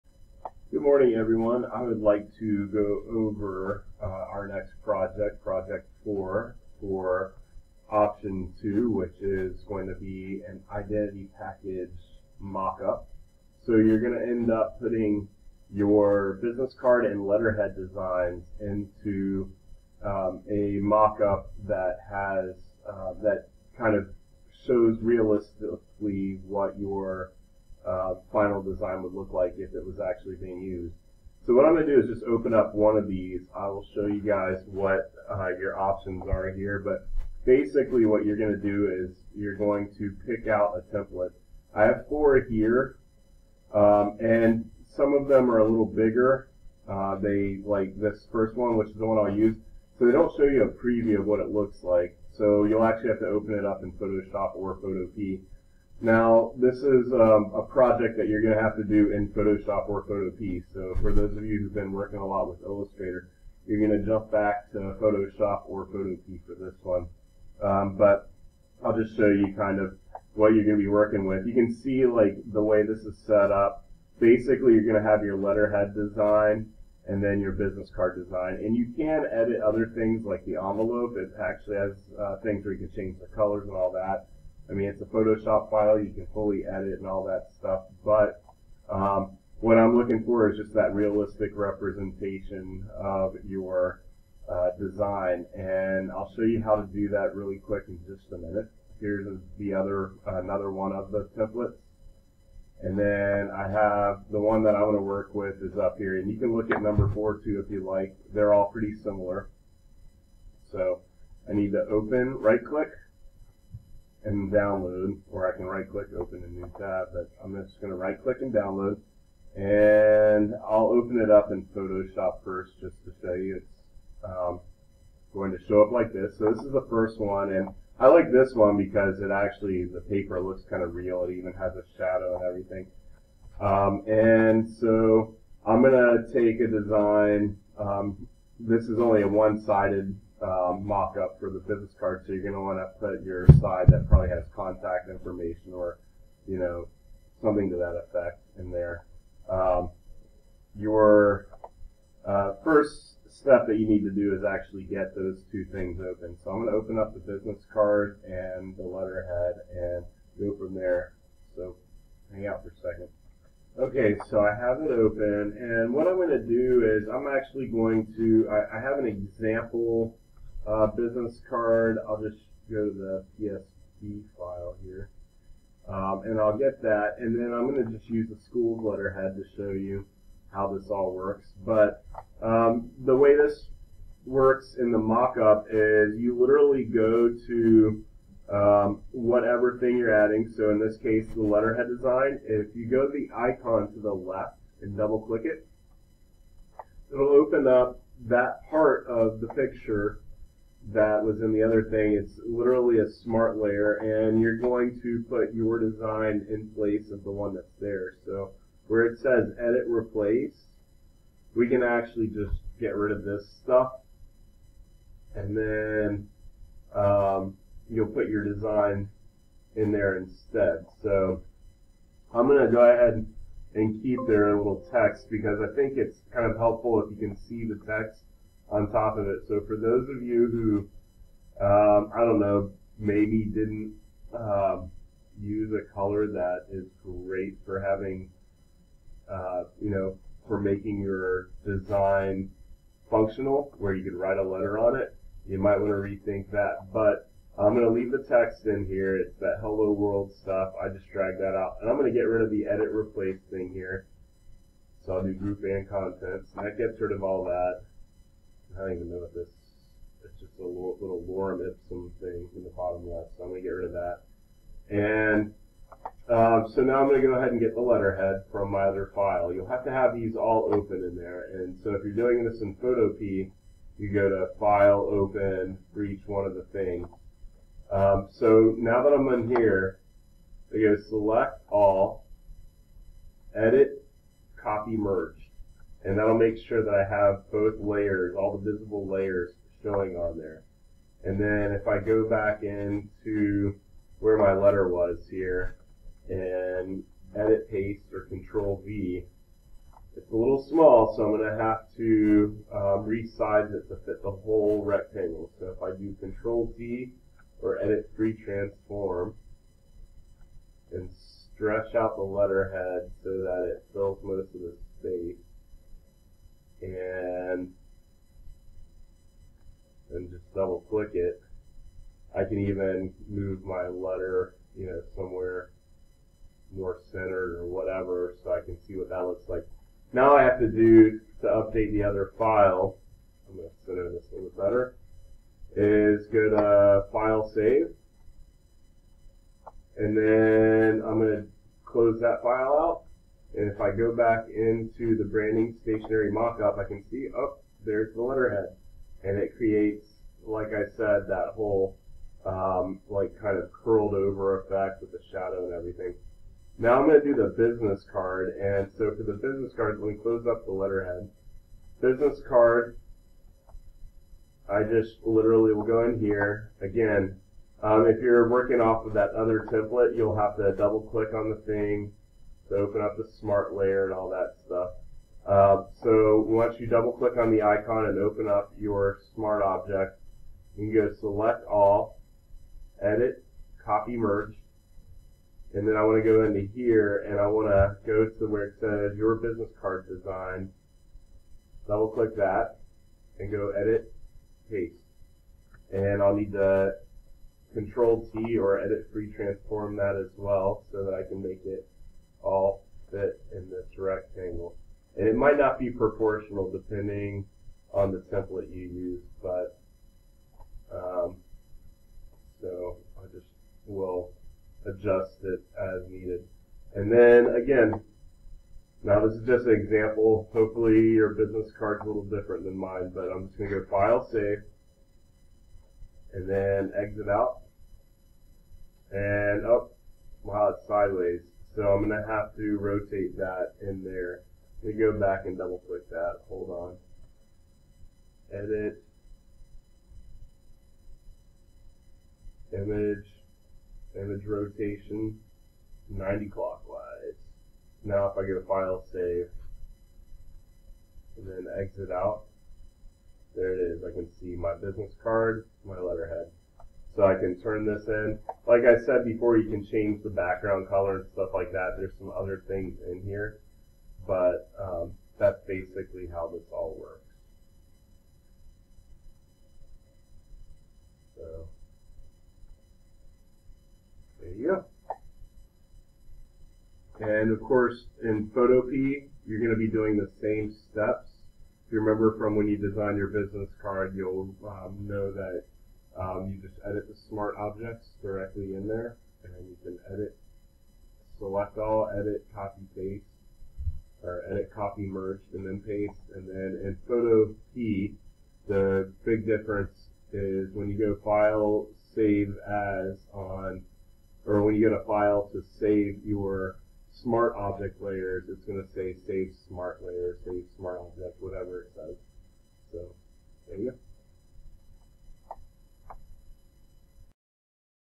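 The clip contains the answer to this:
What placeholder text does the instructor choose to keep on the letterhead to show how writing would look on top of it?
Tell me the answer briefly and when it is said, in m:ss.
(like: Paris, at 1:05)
Hello world, at 4:09.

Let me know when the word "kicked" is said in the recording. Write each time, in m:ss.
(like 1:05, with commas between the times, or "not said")
not said.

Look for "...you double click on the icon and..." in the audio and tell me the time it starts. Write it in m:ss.
6:16.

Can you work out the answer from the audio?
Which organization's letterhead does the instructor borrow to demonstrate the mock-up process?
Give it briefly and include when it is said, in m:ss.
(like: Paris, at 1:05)
The school's, at 2:58.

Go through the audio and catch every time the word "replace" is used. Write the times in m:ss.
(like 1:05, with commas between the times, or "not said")
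3:29, 4:12.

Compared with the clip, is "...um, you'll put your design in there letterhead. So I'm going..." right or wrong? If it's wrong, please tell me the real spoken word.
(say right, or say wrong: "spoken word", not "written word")
wrong: "instead", not "letterhead".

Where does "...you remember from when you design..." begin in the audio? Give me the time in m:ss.
8:01.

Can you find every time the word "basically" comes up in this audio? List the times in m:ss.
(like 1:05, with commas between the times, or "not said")
0:37, 1:14, 7:45.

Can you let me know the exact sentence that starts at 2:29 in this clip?
Um, your uh, first step that you need to do is actually get those two things open.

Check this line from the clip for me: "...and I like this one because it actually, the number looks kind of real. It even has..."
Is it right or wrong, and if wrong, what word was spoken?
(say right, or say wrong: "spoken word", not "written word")
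wrong: "paper", not "number".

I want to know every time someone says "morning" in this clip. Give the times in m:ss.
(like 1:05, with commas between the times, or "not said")
0:00.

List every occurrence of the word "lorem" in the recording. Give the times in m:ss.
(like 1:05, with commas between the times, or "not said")
4:21.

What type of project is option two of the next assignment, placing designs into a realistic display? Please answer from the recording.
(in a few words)
Identity package mock-up.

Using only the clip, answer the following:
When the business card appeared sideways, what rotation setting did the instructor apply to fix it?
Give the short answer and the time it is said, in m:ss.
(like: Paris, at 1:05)
90 clockwise, at 7:26.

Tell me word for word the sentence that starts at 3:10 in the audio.
So in this case, the letterhead design.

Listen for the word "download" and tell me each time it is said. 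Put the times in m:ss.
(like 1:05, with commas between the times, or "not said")
1:54, 1:58.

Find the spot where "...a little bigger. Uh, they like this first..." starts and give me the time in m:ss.
0:45.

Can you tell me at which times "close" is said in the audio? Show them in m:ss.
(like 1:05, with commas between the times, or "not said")
5:41, 6:00.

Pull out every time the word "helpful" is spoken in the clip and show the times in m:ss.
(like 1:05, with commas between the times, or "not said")
3:46.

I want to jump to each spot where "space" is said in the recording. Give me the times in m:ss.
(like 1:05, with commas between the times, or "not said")
5:14.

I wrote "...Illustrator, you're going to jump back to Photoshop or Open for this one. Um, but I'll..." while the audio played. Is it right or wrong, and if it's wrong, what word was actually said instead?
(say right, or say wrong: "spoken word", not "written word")
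wrong: "Photopea", not "Open".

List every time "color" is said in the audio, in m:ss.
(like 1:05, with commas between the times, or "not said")
1:23, 3:55, 7:40.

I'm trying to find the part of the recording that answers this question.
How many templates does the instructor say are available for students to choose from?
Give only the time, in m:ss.
0:41.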